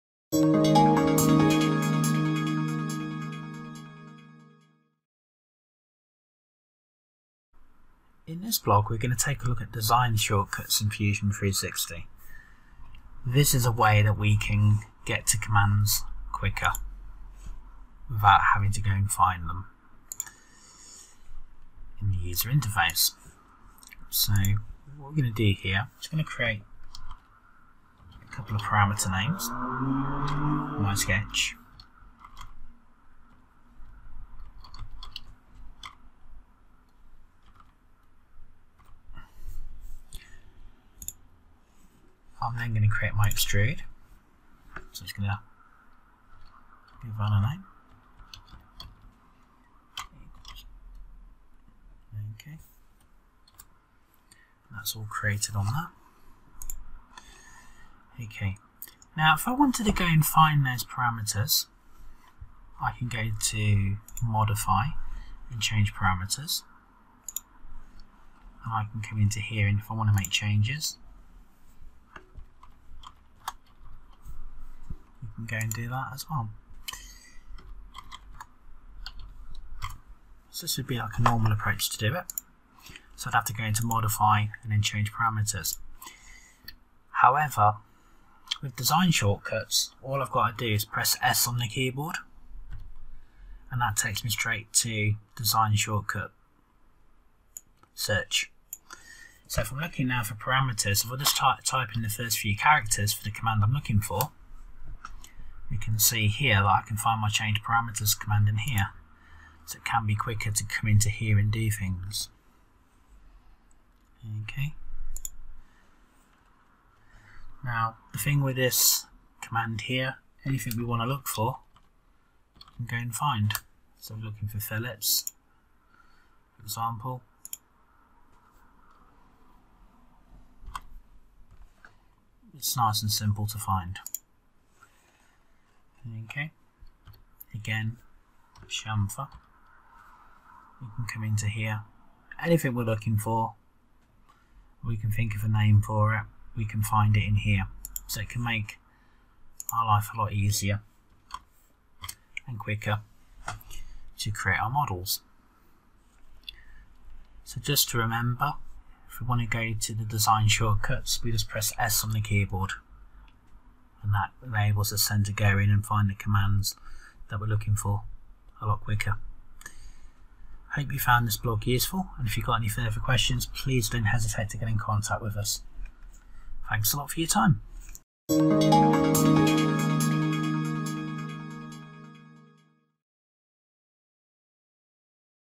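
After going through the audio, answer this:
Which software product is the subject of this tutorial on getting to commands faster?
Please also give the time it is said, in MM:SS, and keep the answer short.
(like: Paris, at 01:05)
Fusion 360, at 00:10.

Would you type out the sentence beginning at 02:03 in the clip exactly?
So we're looking for fillets, for example.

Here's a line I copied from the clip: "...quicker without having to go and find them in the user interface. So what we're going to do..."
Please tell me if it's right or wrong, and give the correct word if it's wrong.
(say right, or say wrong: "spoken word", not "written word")
right.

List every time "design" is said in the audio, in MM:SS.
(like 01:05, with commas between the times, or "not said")
00:09, 01:28, 01:35, 02:40.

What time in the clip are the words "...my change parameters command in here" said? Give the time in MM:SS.
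01:47.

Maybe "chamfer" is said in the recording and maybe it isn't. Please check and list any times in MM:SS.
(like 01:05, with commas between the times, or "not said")
02:18.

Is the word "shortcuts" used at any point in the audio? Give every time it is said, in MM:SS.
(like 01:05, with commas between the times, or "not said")
00:10, 01:29, 01:35, 02:40.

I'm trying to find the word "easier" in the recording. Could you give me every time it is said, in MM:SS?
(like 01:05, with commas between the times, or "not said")
02:30.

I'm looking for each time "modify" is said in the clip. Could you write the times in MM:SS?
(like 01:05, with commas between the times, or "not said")
01:04, 01:23.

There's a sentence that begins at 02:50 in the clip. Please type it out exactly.
Hope you found this blog useful and if you've got any further questions please don't hesitate to get in contact with us.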